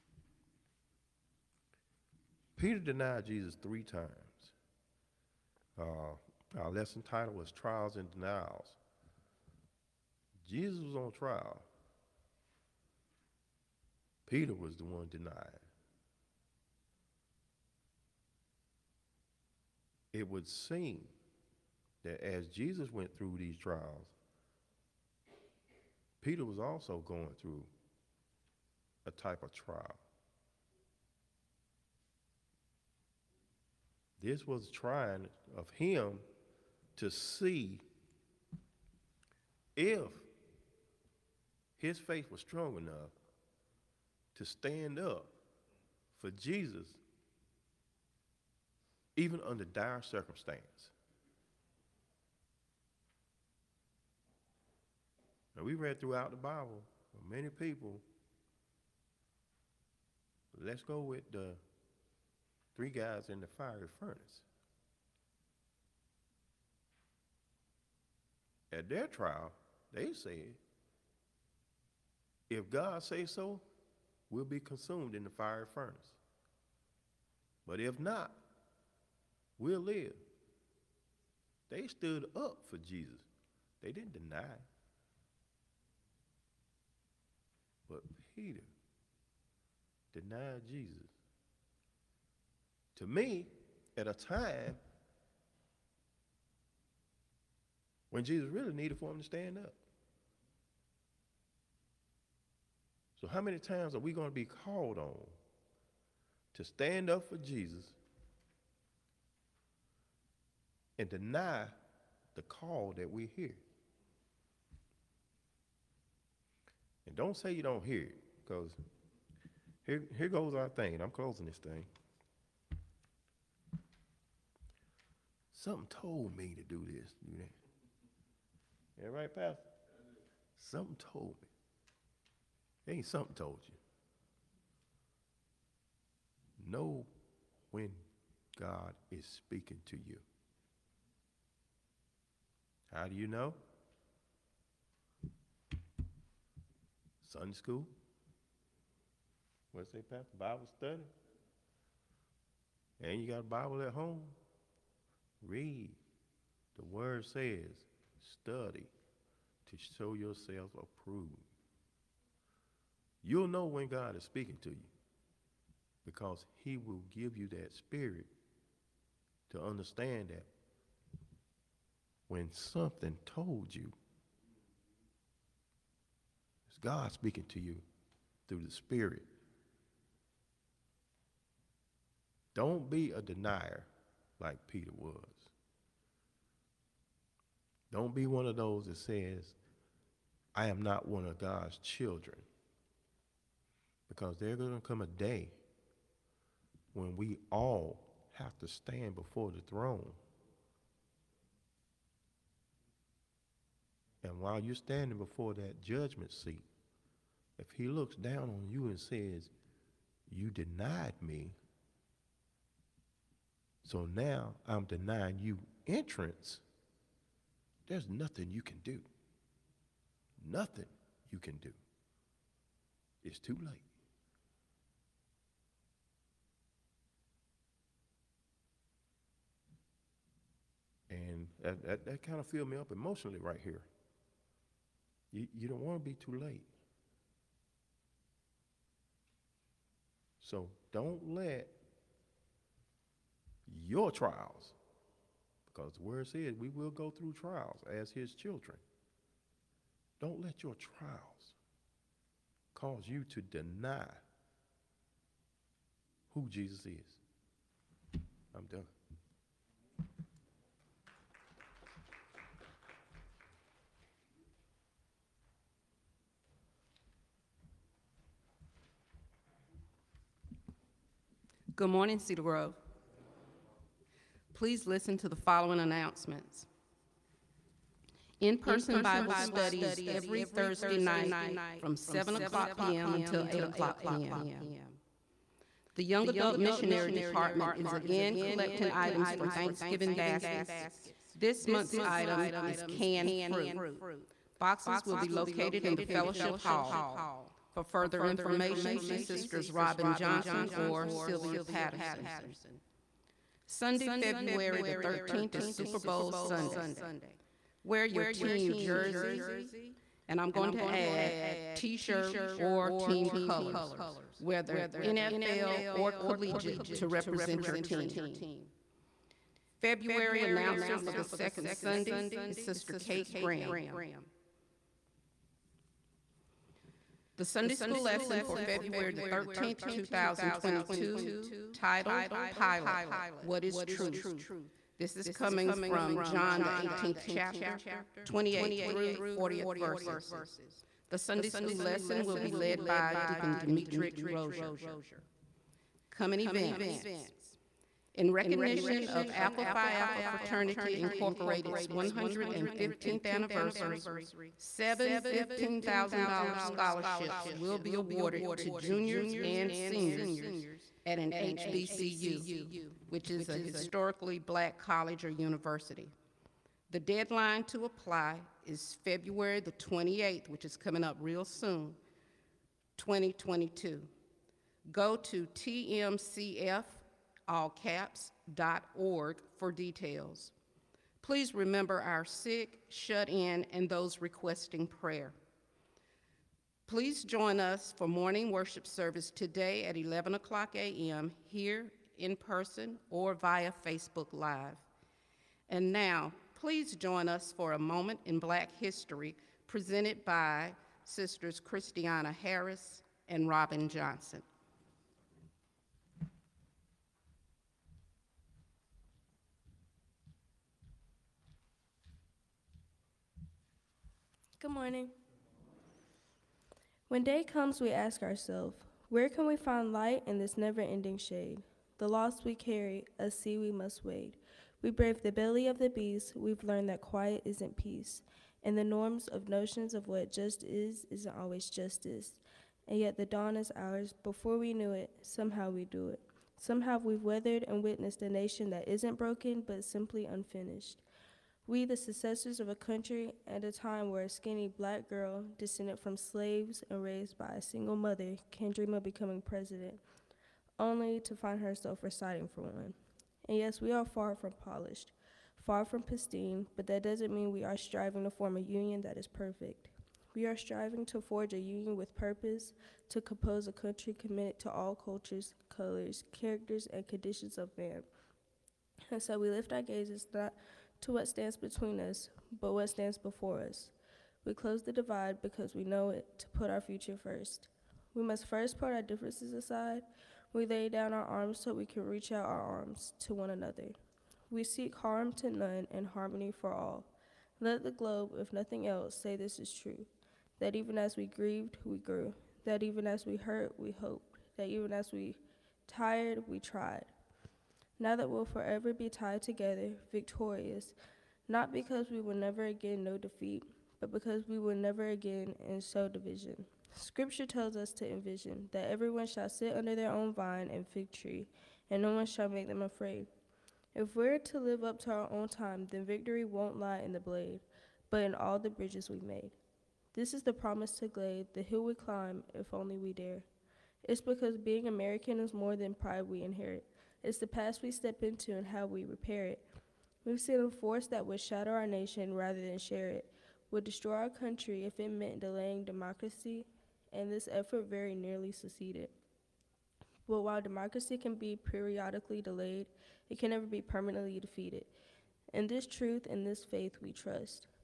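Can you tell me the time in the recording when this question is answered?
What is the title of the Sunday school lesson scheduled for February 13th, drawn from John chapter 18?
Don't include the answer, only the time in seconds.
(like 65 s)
332 s.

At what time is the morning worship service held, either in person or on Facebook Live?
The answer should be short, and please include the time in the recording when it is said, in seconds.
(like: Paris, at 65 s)
11 a.m., at 389 s.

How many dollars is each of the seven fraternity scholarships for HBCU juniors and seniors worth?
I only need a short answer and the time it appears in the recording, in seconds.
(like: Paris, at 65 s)
$15,000, at 355 s.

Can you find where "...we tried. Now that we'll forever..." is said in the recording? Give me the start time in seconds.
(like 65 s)
496 s.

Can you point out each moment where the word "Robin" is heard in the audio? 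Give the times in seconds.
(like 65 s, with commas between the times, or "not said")
299 s, 403 s.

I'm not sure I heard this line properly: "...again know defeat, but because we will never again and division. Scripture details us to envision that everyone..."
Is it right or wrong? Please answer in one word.
wrong.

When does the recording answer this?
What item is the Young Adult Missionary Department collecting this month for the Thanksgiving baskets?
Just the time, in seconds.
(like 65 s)
292 s.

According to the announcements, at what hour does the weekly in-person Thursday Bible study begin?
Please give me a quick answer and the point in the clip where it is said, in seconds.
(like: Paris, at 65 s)
7 p.m., at 281 s.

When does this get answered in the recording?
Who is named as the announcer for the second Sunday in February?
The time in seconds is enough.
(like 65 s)
322 s.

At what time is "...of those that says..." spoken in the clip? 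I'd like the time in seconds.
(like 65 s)
188 s.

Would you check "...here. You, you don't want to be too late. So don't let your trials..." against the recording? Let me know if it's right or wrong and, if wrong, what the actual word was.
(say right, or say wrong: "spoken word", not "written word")
right.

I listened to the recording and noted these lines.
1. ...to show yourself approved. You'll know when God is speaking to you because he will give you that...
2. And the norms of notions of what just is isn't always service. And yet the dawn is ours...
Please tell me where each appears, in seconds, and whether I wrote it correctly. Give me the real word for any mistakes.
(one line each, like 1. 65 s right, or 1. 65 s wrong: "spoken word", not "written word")
1. 159 s right
2. 428 s wrong: "justice", not "service".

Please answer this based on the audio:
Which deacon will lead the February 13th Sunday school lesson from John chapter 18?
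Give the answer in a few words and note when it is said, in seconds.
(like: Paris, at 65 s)
Dimitri Rozier, at 343 s.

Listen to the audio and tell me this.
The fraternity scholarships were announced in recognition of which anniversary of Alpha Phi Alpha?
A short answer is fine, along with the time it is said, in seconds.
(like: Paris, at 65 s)
115th, at 351 s.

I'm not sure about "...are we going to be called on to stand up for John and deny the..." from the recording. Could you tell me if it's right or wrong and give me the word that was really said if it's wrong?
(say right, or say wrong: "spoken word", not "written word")
wrong: "Jesus", not "John".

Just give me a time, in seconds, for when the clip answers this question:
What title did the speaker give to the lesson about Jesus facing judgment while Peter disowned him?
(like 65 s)
7 s.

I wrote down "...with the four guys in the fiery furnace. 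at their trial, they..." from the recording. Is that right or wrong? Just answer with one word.
wrong.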